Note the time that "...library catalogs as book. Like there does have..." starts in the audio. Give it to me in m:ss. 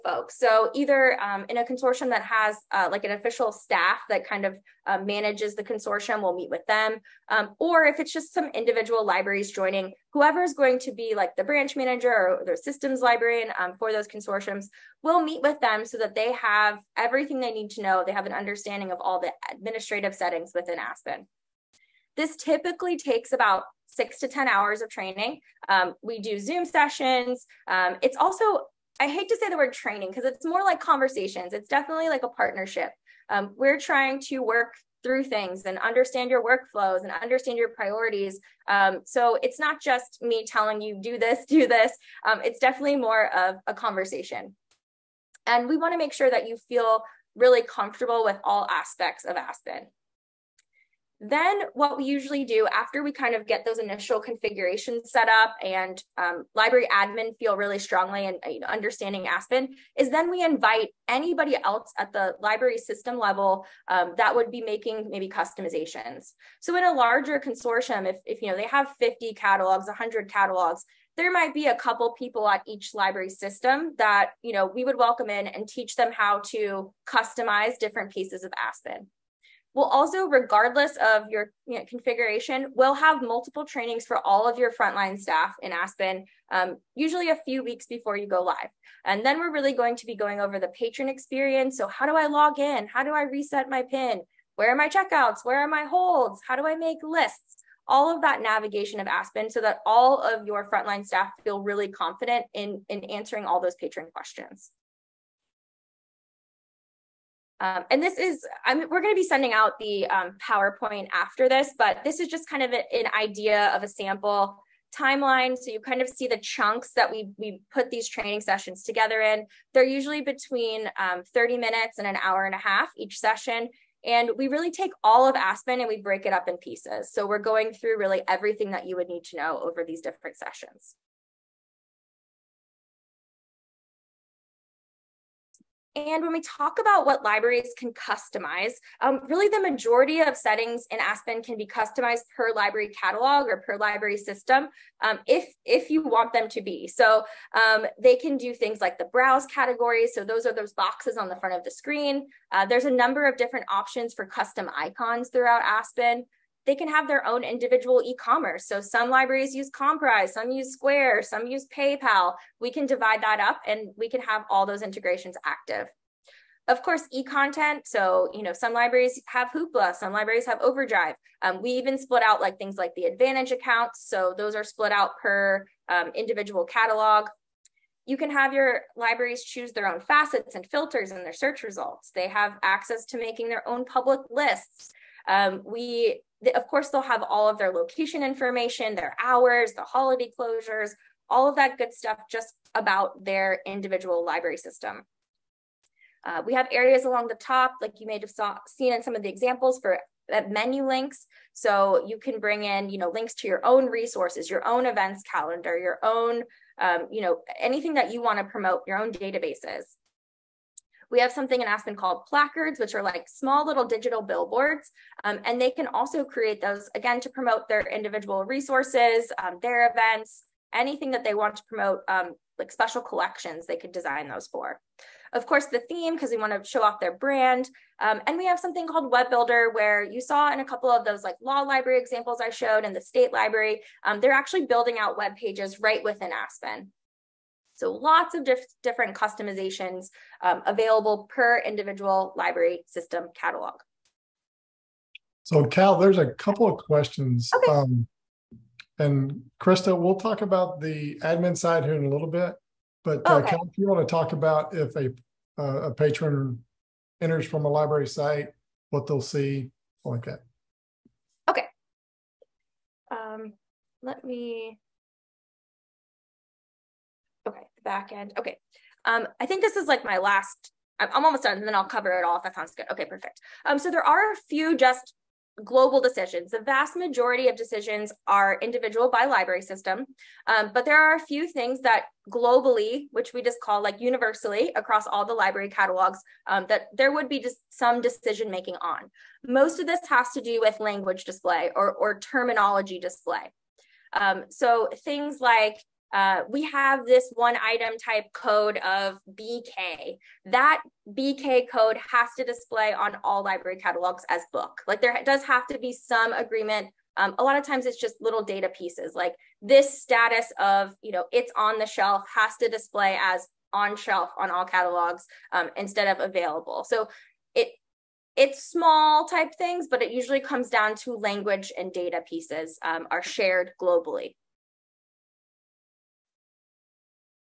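5:03.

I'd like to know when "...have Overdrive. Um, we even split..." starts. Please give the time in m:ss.
2:50.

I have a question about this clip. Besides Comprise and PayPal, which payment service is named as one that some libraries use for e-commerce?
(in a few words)
Square.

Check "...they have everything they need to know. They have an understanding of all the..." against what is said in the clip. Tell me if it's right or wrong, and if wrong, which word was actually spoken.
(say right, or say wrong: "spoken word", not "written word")
right.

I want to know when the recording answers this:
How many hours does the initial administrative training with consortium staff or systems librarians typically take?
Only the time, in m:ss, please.
0:23.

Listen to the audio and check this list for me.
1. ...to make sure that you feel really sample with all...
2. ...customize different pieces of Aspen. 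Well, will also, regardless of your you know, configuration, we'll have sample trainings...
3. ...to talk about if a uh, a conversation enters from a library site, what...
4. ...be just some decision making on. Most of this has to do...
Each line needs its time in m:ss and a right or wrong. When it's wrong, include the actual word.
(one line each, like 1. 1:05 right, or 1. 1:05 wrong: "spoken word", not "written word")
1. 0:45 wrong: "comfortable", not "sample"
2. 1:17 wrong: "multiple", not "sample"
3. 4:14 wrong: "patron", not "conversation"
4. 4:47 right.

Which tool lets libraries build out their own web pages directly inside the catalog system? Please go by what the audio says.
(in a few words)
Web Builder.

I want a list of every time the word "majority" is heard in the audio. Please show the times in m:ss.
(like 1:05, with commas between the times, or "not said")
2:19, 4:36.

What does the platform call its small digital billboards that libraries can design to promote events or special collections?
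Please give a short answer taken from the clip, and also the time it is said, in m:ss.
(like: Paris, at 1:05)
placards, at 3:32.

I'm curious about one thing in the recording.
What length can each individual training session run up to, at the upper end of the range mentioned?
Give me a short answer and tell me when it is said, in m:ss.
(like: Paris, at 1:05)
an hour and a half, at 2:02.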